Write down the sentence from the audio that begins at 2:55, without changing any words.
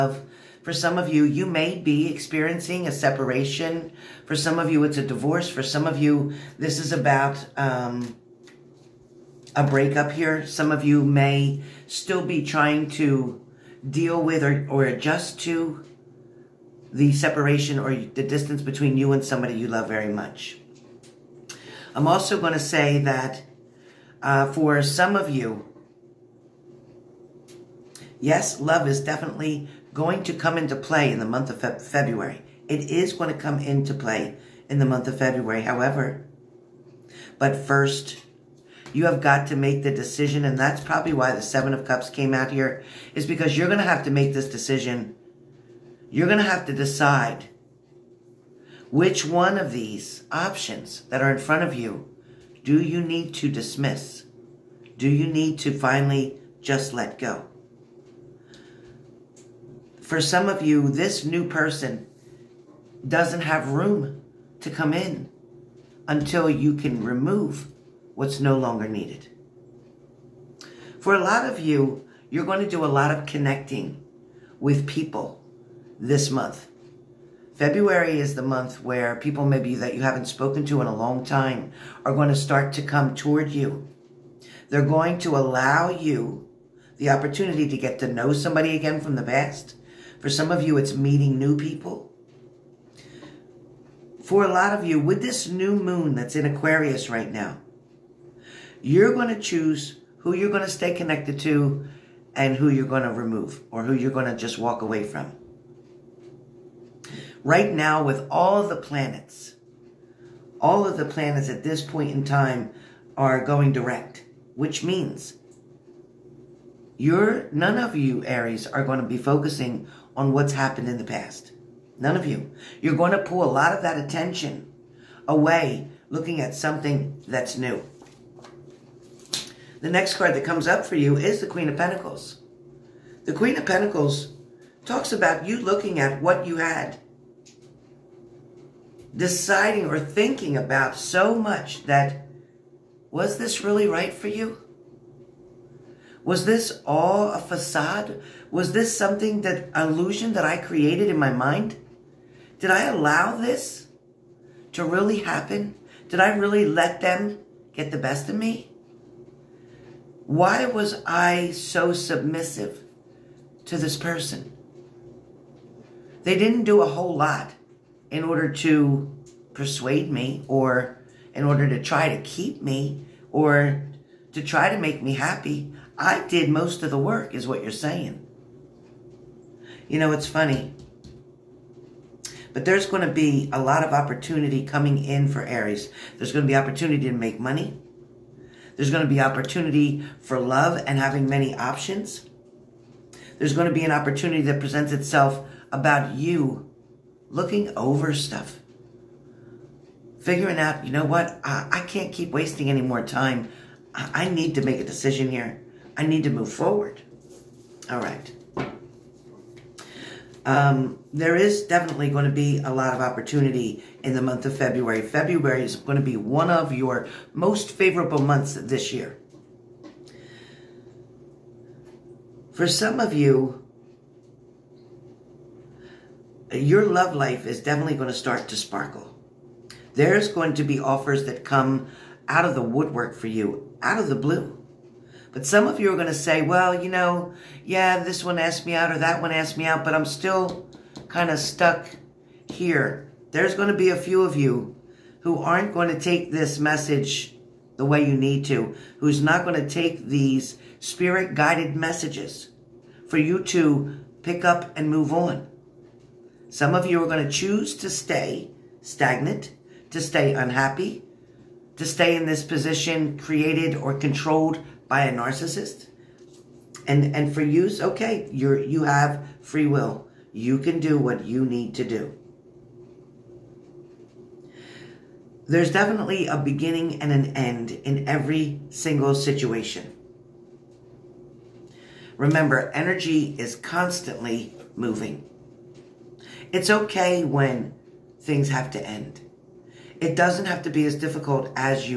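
I did most of the work, is what you're saying.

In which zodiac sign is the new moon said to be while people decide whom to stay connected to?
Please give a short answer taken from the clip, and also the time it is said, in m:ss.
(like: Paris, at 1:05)
Aquarius, at 1:36.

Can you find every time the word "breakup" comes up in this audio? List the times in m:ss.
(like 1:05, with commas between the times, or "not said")
0:09.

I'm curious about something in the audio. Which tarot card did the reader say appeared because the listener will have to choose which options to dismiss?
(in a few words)
Seven of Cups.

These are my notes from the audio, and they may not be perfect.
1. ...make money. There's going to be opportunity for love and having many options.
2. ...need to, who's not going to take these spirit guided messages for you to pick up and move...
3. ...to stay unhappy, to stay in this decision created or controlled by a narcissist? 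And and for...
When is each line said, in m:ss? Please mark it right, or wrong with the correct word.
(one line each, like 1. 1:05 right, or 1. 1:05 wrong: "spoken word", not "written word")
1. 3:07 right
2. 4:08 right
3. 4:19 wrong: "position", not "decision".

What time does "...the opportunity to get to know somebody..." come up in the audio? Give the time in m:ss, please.
1:26.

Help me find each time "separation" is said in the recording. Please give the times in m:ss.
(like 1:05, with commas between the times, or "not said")
0:02, 0:17.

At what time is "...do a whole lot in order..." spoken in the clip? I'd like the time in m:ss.
2:46.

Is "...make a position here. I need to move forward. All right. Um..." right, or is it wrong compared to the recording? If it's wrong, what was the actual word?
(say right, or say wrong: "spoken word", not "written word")
wrong: "decision", not "position".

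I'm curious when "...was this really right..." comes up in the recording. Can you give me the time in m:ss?
2:23.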